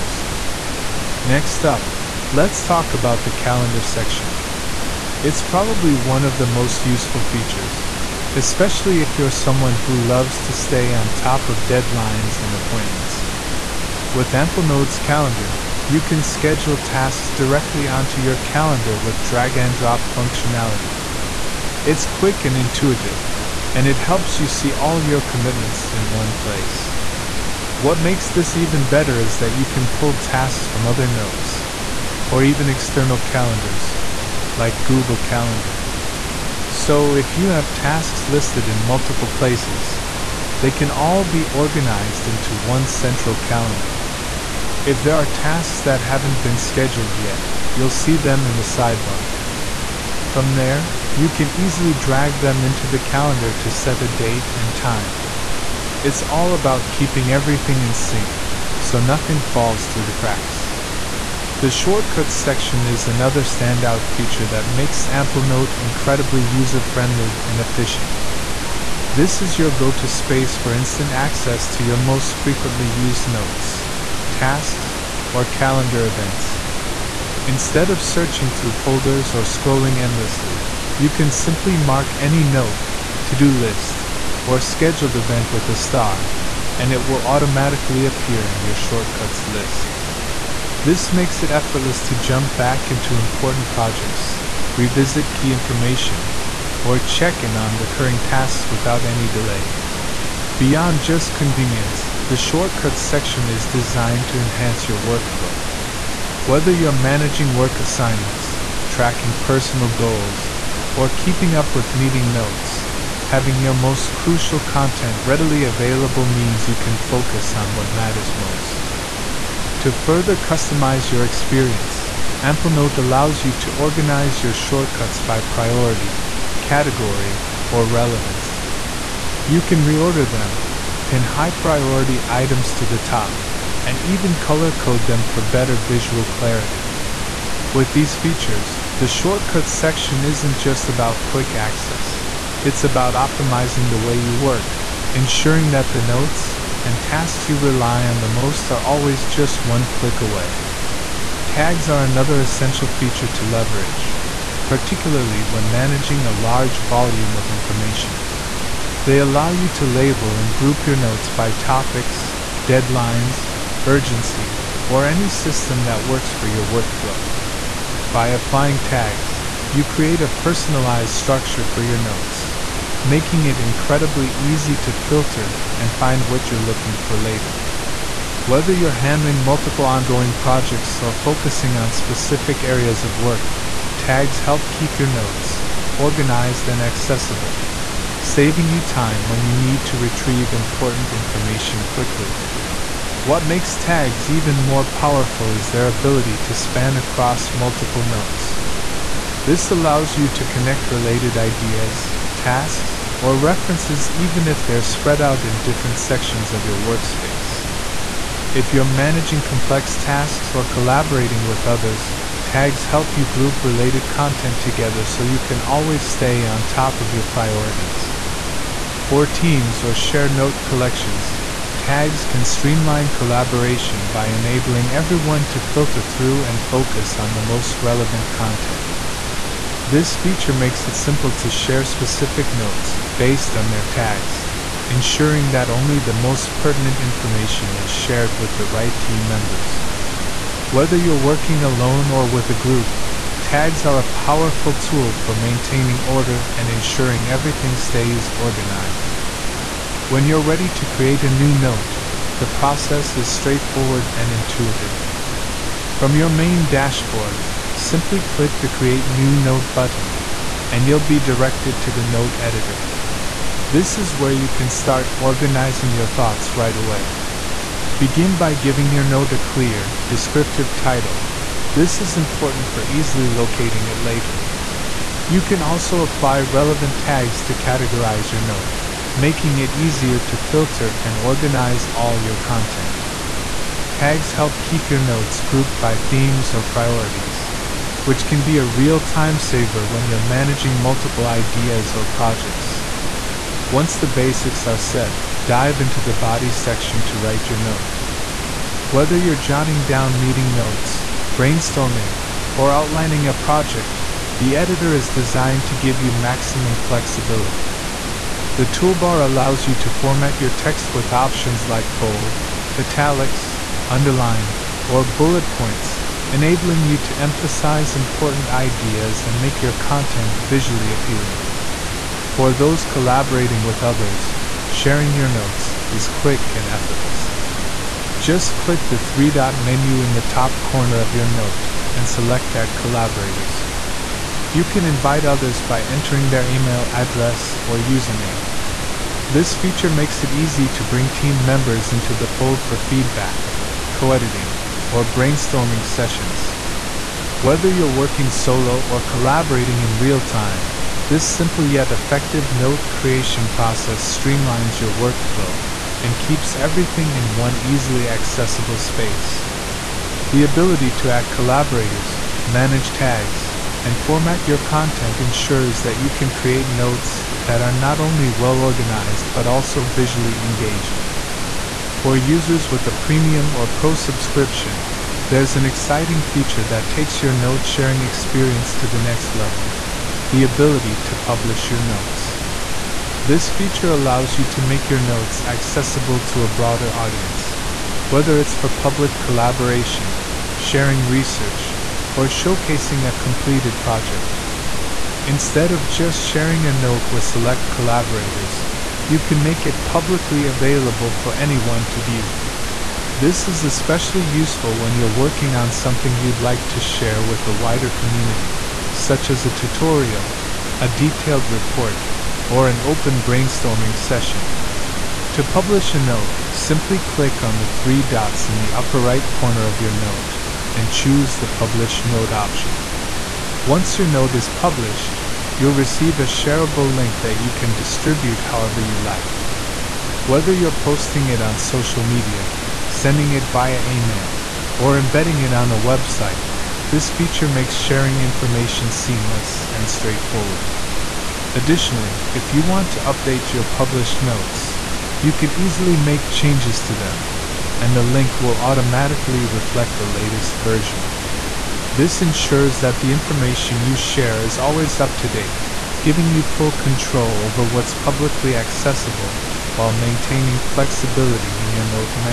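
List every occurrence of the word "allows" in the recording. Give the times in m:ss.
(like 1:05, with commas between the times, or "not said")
2:02, 2:39, 3:19, 5:09, 6:23.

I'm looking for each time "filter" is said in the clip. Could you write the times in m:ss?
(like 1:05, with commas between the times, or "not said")
2:54, 3:45, 4:40.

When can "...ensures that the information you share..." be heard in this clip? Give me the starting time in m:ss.
7:32.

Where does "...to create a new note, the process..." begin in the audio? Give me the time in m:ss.
4:10.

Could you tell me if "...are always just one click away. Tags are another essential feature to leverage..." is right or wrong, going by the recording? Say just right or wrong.
right.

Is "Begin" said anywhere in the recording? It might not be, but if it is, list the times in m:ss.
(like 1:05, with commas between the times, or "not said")
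4:27.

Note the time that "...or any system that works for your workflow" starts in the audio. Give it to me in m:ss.
2:44.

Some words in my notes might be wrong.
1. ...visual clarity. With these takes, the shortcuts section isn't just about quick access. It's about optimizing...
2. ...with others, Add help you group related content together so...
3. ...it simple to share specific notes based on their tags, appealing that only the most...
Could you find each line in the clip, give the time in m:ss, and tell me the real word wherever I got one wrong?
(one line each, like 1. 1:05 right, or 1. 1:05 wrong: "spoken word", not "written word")
1. 2:15 wrong: "features", not "takes"
2. 3:31 wrong: "Tags", not "Add"
3. 3:50 wrong: "ensuring", not "appealing".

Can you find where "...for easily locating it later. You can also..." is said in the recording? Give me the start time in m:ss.
4:32.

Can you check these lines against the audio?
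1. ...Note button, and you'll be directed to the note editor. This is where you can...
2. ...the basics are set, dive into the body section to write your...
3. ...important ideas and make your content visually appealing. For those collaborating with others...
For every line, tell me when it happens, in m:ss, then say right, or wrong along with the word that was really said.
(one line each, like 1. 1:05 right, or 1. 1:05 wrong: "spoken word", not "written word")
1. 4:19 right
2. 4:53 right
3. 5:17 right.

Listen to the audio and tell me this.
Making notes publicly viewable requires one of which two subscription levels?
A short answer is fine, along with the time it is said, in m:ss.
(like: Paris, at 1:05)
premium or pro, at 6:12.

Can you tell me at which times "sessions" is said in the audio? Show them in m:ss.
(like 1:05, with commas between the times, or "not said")
5:45, 6:53.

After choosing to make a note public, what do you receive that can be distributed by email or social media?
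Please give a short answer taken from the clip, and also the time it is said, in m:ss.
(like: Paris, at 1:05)
a shareable link, at 7:06.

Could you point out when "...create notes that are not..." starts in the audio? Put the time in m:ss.
6:06.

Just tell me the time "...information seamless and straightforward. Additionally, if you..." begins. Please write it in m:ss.
7:18.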